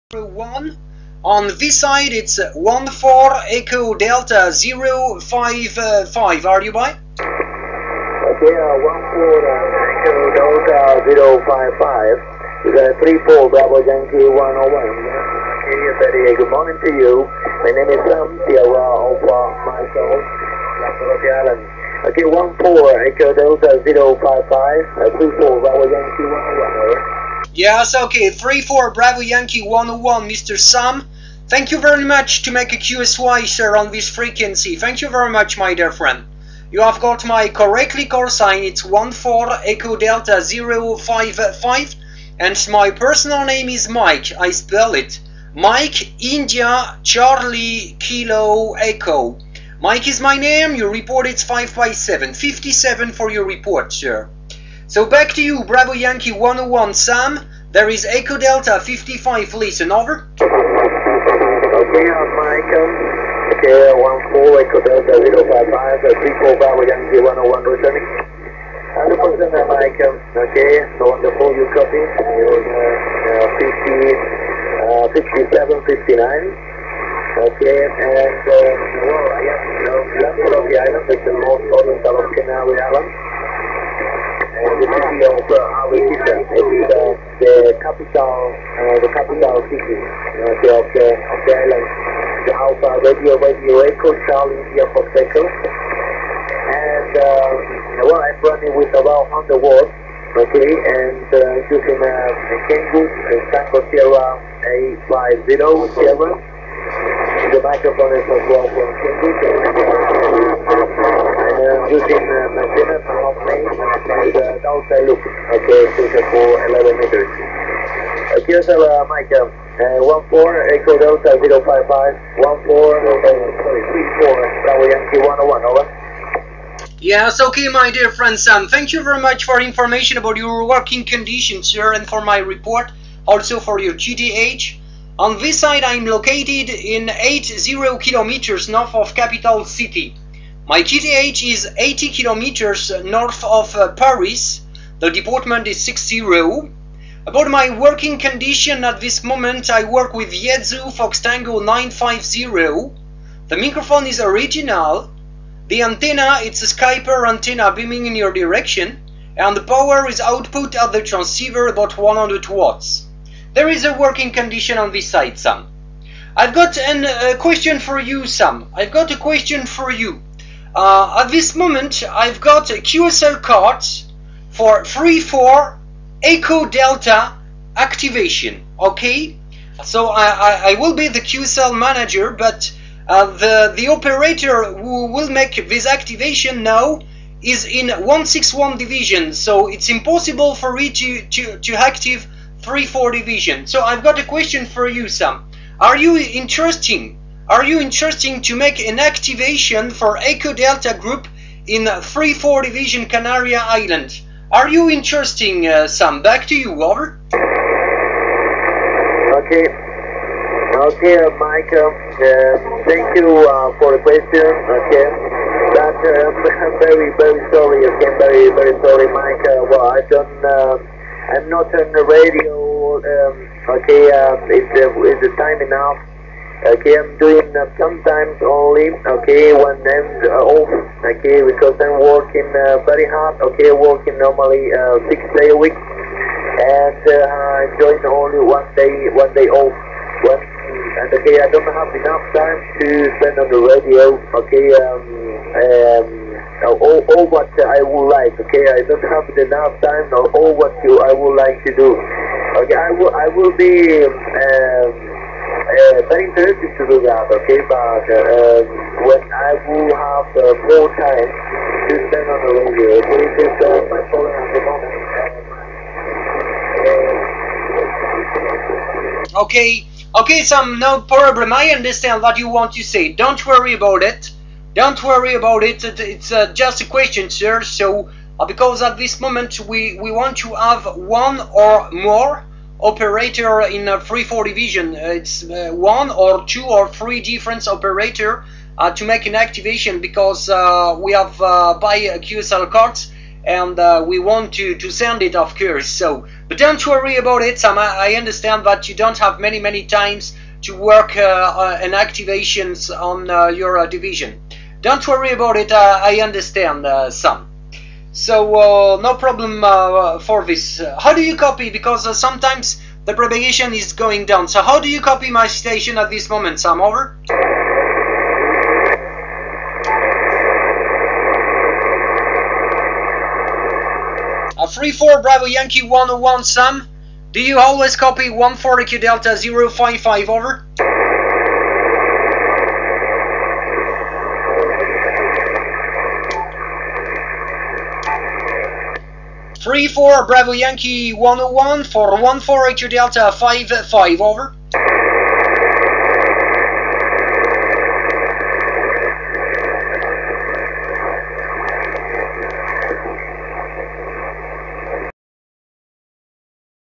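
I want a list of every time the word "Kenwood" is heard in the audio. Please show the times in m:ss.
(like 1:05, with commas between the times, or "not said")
1:42, 1:49.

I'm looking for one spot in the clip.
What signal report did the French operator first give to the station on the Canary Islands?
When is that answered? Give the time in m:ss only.
0:51.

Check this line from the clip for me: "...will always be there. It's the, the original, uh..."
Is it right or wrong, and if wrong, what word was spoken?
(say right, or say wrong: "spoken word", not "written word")
wrong: "capital", not "original".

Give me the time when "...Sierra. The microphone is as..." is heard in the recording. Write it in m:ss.
1:45.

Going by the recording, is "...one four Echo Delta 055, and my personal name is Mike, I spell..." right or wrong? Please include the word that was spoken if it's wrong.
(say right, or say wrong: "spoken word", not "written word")
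right.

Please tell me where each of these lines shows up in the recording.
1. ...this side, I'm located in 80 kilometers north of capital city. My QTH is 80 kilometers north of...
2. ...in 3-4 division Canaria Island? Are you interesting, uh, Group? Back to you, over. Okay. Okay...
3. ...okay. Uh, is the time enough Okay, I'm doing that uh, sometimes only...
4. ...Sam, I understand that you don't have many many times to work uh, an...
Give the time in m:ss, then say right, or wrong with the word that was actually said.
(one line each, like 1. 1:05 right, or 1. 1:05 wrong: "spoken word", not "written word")
1. 2:15 right
2. 3:21 wrong: "Sam", not "Group"
3. 3:43 right
4. 4:57 right.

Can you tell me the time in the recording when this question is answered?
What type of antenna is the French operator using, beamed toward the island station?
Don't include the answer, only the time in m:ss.
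2:36.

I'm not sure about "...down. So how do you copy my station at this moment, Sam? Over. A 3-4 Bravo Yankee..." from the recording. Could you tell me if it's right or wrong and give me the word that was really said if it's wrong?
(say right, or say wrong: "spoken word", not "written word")
right.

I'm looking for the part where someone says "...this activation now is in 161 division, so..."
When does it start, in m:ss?
3:05.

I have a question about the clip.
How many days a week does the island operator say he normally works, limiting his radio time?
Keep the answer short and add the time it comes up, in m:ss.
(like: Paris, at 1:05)
6, at 3:55.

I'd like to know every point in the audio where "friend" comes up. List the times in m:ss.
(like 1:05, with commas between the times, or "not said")
0:35, 2:08.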